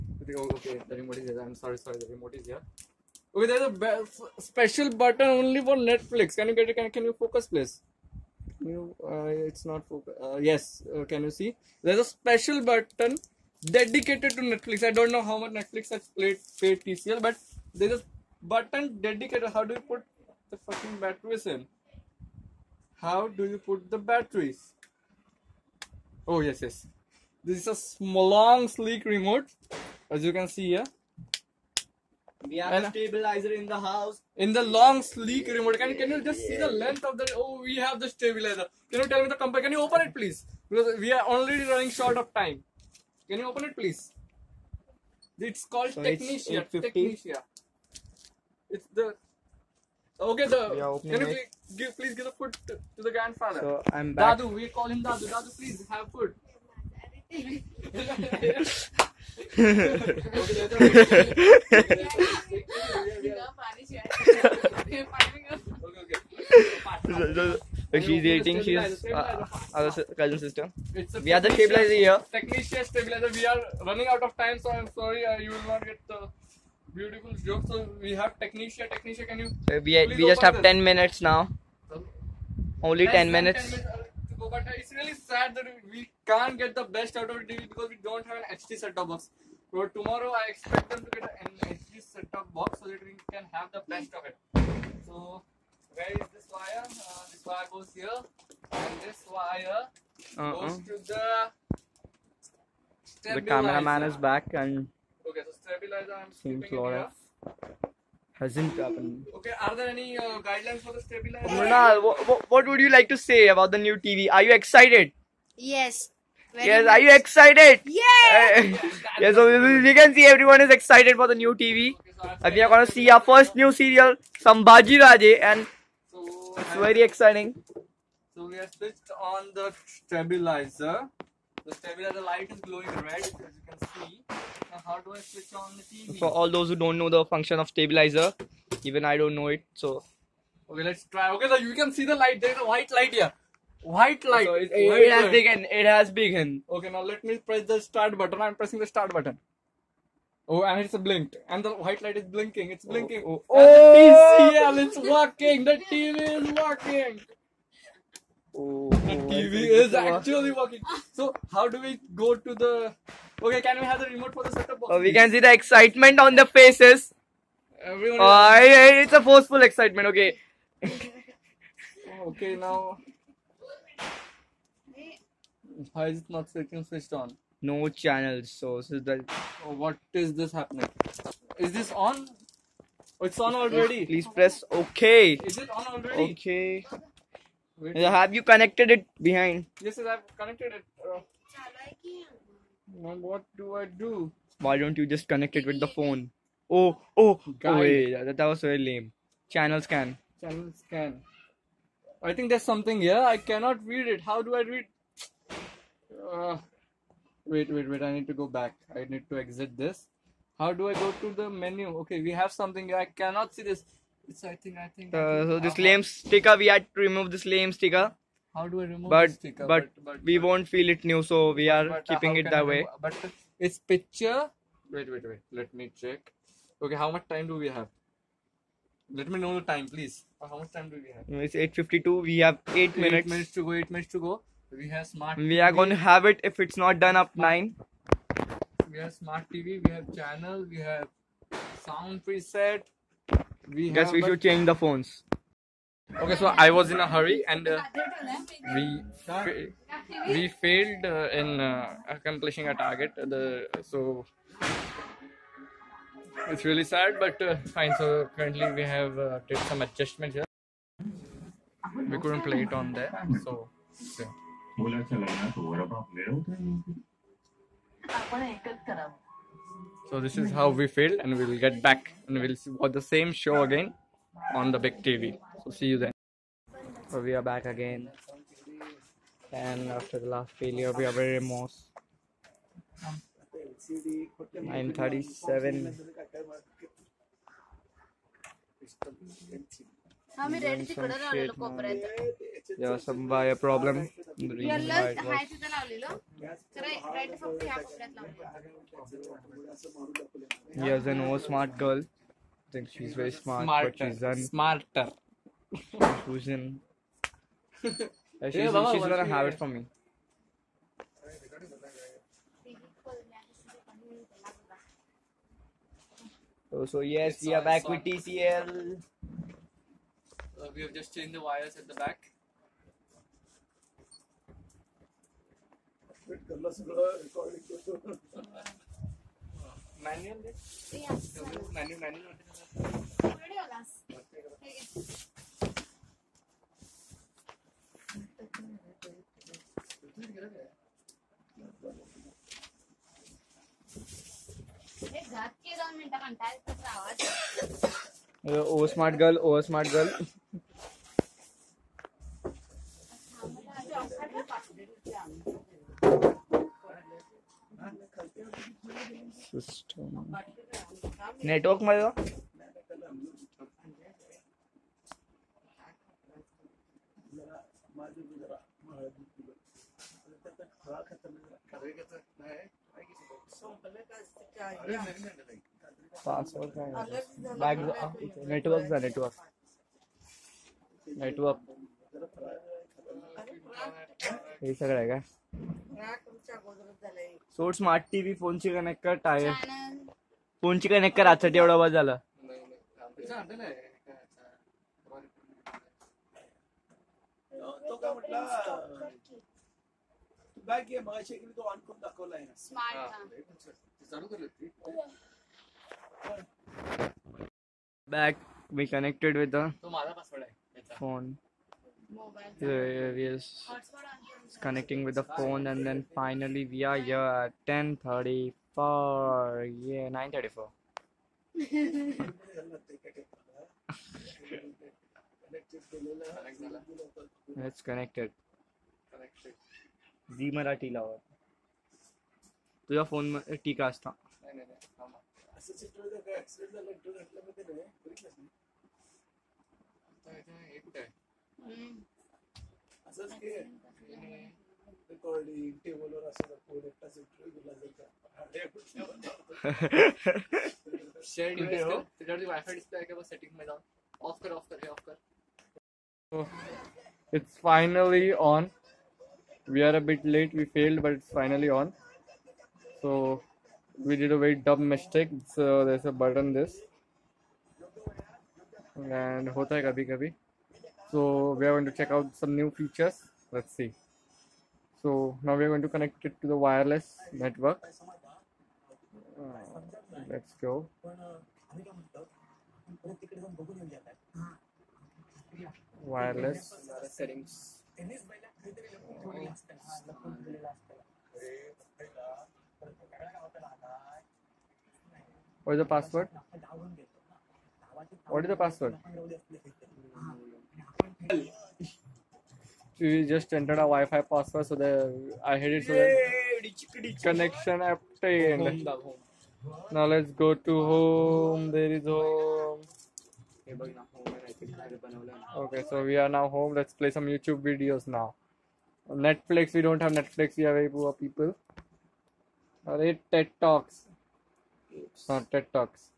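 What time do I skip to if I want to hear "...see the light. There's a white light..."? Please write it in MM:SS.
02:21.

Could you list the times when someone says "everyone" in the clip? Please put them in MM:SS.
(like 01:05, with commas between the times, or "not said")
02:00, 02:47.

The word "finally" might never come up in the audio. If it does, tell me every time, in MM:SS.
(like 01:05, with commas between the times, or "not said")
06:56, 07:41.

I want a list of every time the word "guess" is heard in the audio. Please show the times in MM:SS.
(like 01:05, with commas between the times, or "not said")
04:03.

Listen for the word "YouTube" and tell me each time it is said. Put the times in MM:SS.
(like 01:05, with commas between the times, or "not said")
08:37.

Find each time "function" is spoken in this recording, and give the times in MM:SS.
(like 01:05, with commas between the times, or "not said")
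02:17.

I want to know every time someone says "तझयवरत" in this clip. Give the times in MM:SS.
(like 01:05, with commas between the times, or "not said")
07:31.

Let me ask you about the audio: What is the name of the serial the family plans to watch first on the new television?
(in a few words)
Sambhaji Raje.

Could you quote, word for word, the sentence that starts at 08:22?
we just entered a Wi-Fi password, so the I hit it.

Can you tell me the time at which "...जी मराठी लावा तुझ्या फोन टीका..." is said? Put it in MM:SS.
07:10.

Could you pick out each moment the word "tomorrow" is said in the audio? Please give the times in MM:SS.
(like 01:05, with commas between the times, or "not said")
01:29.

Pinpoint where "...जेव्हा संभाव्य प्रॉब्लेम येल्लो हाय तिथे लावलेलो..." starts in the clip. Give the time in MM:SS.
04:52.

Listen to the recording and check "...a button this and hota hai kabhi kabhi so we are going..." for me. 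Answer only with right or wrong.
right.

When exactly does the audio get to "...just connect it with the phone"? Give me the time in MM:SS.
03:15.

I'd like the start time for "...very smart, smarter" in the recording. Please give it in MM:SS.
05:03.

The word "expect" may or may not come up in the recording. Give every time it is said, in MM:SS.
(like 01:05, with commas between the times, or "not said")
01:30.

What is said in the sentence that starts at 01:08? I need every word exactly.
She's uh, uh, our cousin sister.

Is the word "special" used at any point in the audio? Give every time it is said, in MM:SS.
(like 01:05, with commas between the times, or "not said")
00:04, 00:12.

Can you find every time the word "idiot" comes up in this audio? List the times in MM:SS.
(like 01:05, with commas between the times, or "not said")
not said.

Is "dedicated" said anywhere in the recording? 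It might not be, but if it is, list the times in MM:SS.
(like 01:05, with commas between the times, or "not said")
00:13, 00:19.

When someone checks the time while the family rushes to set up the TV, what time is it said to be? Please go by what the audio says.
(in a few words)
8:52.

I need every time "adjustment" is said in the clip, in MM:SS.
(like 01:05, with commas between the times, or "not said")
04:19.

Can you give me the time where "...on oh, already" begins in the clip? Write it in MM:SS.
03:03.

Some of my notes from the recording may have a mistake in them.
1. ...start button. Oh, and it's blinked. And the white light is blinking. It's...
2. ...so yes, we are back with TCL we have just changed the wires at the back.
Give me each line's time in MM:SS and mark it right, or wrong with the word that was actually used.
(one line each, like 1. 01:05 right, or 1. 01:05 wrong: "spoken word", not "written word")
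1. 02:28 right
2. 05:16 right.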